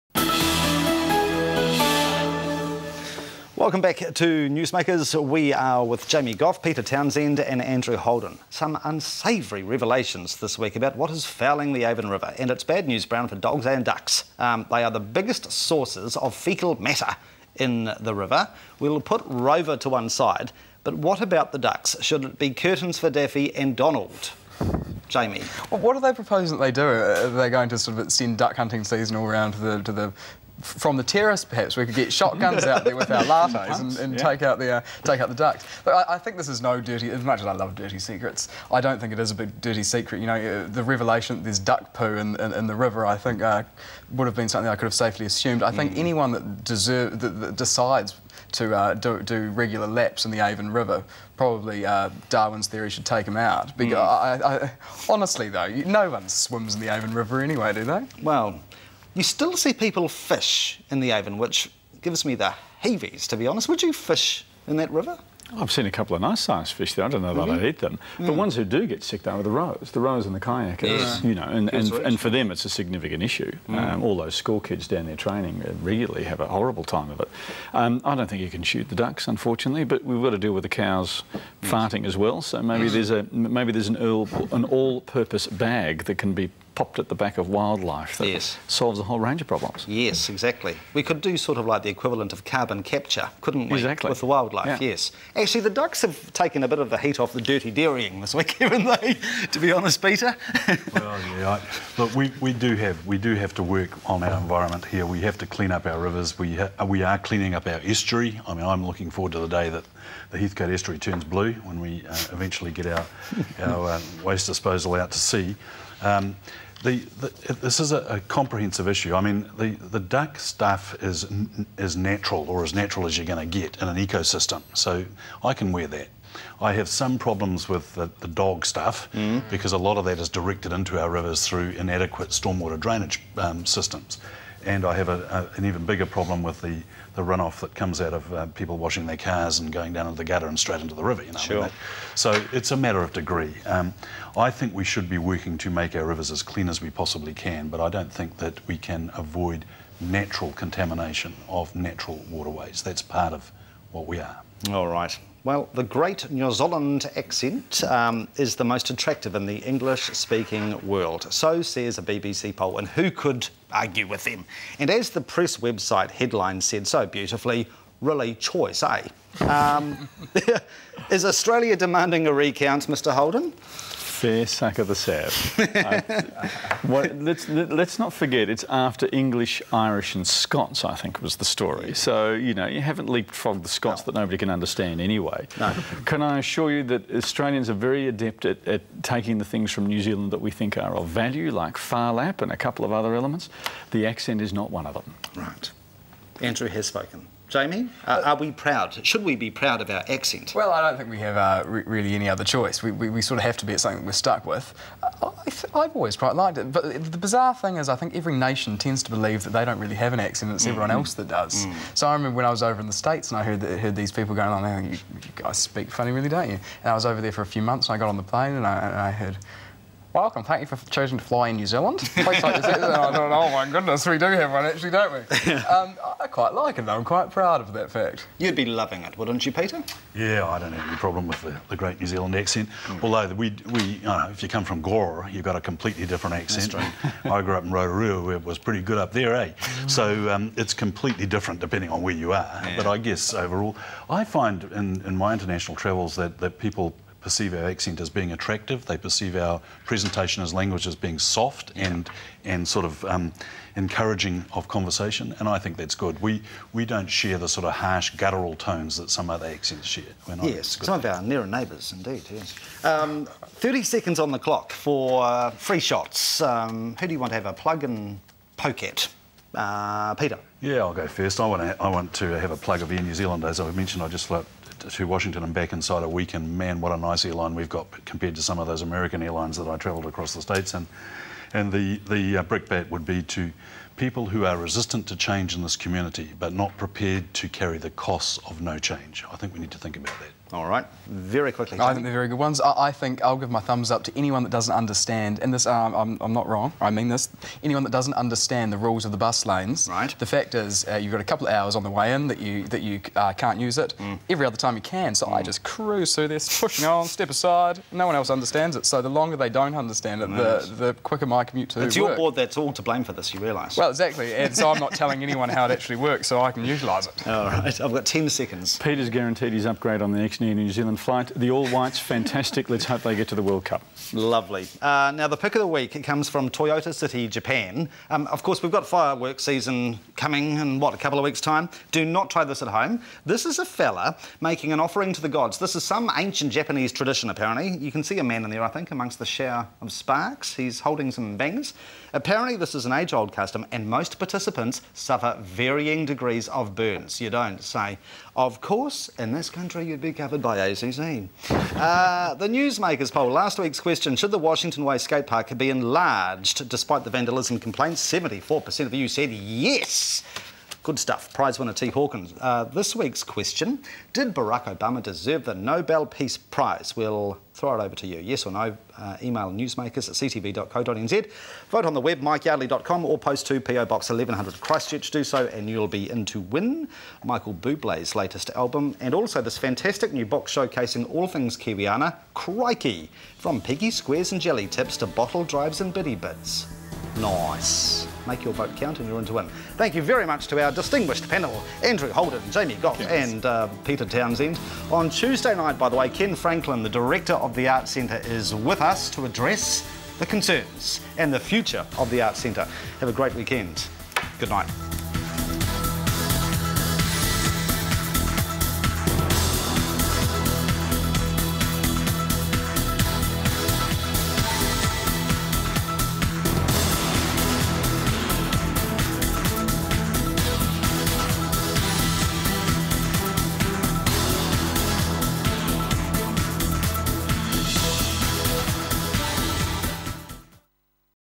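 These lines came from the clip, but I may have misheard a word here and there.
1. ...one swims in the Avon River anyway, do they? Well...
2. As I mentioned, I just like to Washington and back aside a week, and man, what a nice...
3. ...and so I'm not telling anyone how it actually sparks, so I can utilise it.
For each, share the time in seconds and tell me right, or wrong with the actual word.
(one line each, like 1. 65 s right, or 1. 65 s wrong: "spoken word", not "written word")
1. 56 s right
2. 273 s wrong: "inside", not "aside"
3. 314 s wrong: "works", not "sparks".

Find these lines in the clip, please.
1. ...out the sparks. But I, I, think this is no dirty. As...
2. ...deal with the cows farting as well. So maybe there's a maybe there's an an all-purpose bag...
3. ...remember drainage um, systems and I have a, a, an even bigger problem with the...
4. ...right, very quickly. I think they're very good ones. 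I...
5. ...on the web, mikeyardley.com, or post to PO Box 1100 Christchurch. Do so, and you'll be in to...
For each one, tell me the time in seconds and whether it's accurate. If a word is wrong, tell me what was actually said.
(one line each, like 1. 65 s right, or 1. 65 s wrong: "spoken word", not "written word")
1. 35 s wrong: "ducks", not "sparks"
2. 80 s right
3. 132 s wrong: "stormwater", not "remember"
4. 290 s right
5. 371 s right.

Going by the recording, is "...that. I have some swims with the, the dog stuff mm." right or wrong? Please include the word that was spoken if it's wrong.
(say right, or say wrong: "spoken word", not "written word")
wrong: "problems", not "swims".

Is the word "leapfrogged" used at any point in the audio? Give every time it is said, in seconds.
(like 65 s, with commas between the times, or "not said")
183 s.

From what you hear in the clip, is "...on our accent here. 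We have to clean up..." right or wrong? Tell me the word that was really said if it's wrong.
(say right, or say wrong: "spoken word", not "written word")
wrong: "environment", not "accent".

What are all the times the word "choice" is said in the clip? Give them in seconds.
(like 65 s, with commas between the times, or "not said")
168 s, 202 s.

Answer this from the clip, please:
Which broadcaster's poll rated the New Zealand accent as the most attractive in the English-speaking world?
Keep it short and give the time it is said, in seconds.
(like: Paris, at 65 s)
BBC, at 162 s.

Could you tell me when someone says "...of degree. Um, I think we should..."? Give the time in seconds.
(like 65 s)
143 s.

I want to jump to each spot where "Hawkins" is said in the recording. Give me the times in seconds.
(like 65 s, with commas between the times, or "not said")
361 s.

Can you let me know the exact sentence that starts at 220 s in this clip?
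Welcome, thank you for choosing to fly in New Zealand.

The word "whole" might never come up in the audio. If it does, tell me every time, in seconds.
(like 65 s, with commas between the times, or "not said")
89 s.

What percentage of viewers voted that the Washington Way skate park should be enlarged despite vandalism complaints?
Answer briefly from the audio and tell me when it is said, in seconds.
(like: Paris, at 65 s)
74%, at 358 s.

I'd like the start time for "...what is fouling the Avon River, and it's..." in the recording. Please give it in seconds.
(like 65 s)
10 s.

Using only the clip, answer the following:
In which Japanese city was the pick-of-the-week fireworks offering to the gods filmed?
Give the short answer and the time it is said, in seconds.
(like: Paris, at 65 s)
Toyota City, at 326 s.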